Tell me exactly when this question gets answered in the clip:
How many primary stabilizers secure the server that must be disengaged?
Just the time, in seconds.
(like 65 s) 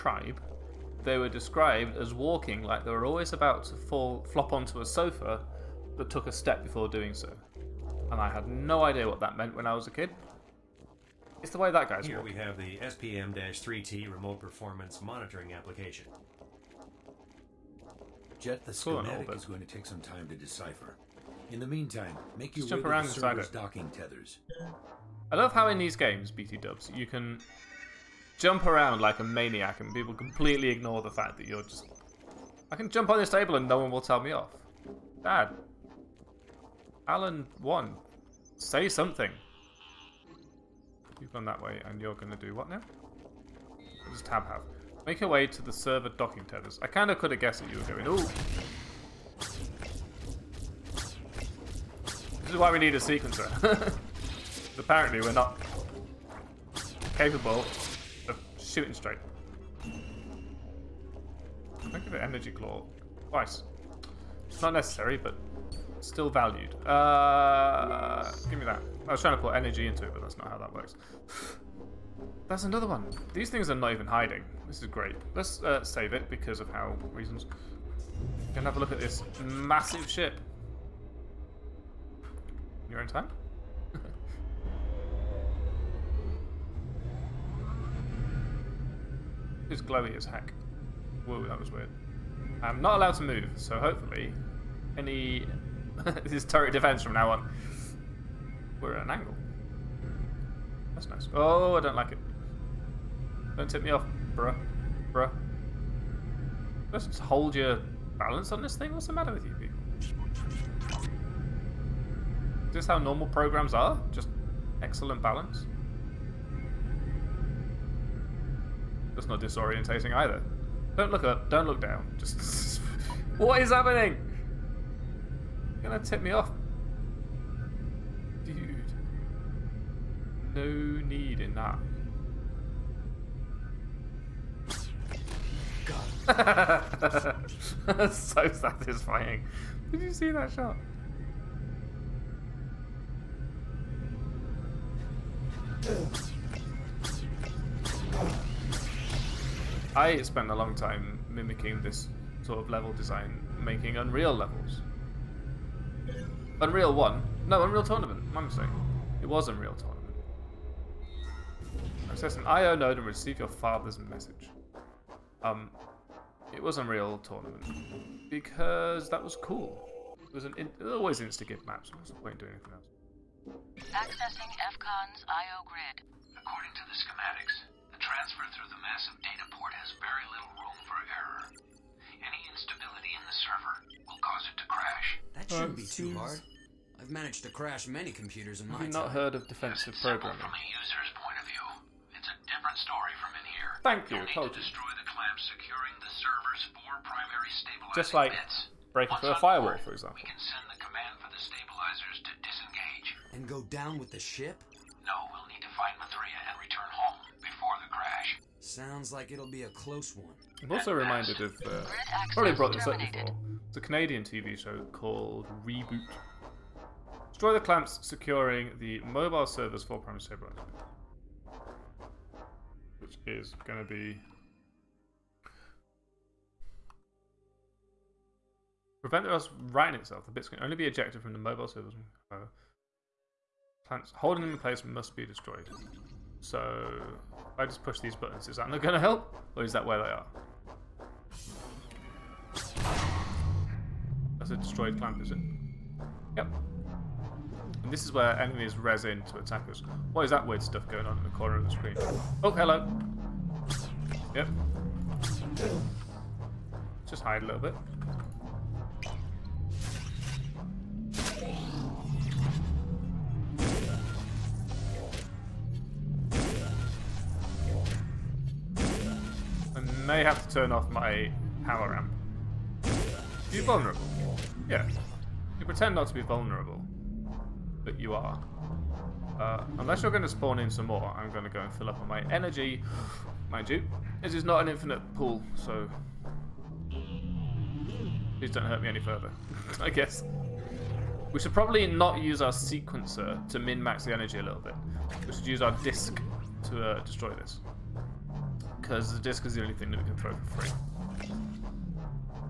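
196 s.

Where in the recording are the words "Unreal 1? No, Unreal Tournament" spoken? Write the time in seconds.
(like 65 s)
156 s.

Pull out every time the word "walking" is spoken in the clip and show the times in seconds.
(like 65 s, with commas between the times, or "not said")
2 s, 12 s.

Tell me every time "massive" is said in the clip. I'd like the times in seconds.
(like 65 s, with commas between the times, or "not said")
79 s, 178 s.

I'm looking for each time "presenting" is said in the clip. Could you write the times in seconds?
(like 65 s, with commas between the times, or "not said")
not said.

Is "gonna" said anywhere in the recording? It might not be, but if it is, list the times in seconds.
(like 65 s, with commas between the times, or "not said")
78 s, 125 s.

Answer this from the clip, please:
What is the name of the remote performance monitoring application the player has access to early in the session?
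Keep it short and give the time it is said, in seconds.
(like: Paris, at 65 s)
SPM-3T, at 12 s.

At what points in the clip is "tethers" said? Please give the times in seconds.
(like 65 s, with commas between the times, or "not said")
23 s, 46 s.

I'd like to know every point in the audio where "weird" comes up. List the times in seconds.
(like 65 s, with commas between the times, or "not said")
91 s, 250 s.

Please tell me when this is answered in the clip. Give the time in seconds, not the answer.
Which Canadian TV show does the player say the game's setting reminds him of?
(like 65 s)
215 s.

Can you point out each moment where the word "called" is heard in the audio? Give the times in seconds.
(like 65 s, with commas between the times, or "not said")
214 s.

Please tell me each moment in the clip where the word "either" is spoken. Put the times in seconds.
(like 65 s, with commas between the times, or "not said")
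120 s.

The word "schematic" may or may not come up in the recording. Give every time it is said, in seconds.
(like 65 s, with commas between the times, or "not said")
19 s, 176 s.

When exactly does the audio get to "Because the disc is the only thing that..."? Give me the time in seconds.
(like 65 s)
298 s.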